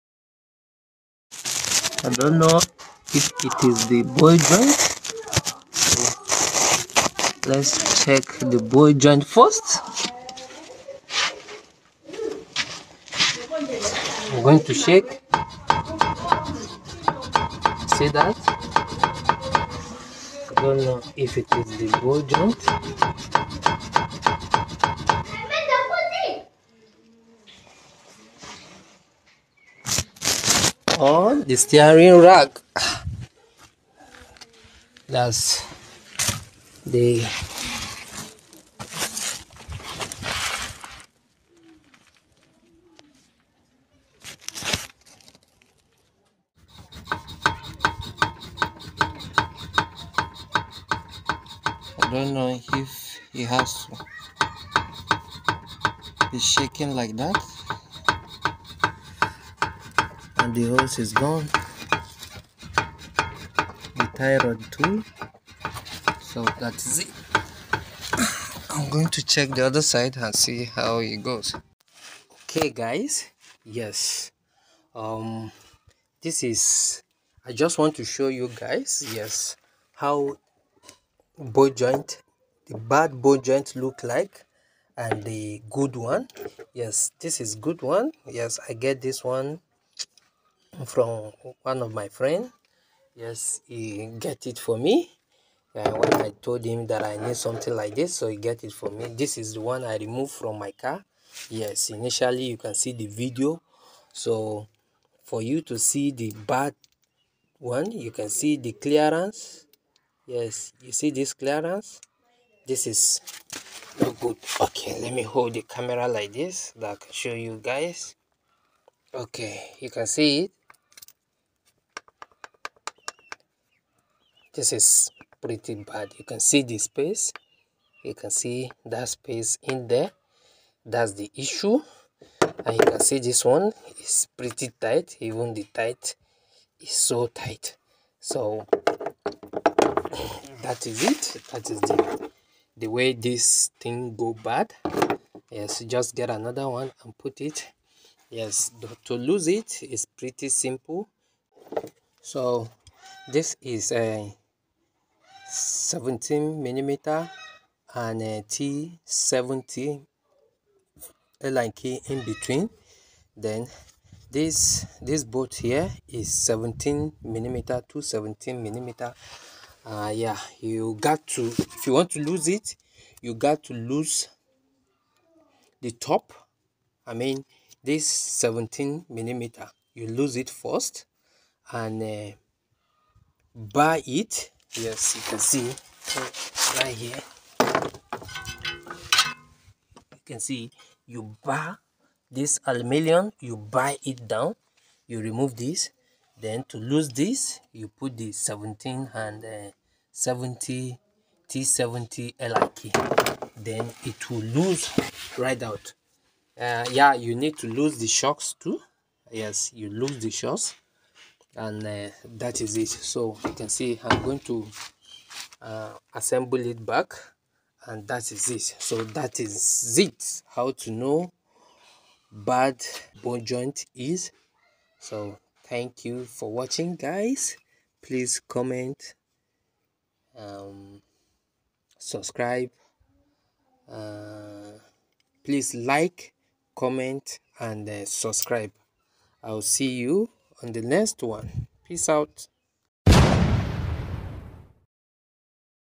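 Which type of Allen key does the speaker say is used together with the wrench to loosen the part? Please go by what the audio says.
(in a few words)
T70.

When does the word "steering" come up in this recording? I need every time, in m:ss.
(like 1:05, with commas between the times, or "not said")
0:31.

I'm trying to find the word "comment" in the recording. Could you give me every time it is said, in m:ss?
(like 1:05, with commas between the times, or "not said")
3:48, 3:56.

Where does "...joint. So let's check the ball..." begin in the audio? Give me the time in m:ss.
0:04.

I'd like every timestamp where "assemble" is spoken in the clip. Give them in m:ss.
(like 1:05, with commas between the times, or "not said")
3:36.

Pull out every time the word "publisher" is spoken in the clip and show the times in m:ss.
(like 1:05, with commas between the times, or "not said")
not said.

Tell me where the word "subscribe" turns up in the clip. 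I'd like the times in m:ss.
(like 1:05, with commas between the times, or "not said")
3:51, 3:58.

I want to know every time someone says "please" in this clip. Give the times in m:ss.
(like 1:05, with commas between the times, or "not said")
3:48, 3:55.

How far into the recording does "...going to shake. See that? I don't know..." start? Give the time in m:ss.
0:14.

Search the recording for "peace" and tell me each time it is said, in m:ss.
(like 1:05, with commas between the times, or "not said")
4:01.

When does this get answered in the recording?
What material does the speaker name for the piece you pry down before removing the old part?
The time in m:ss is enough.
3:12.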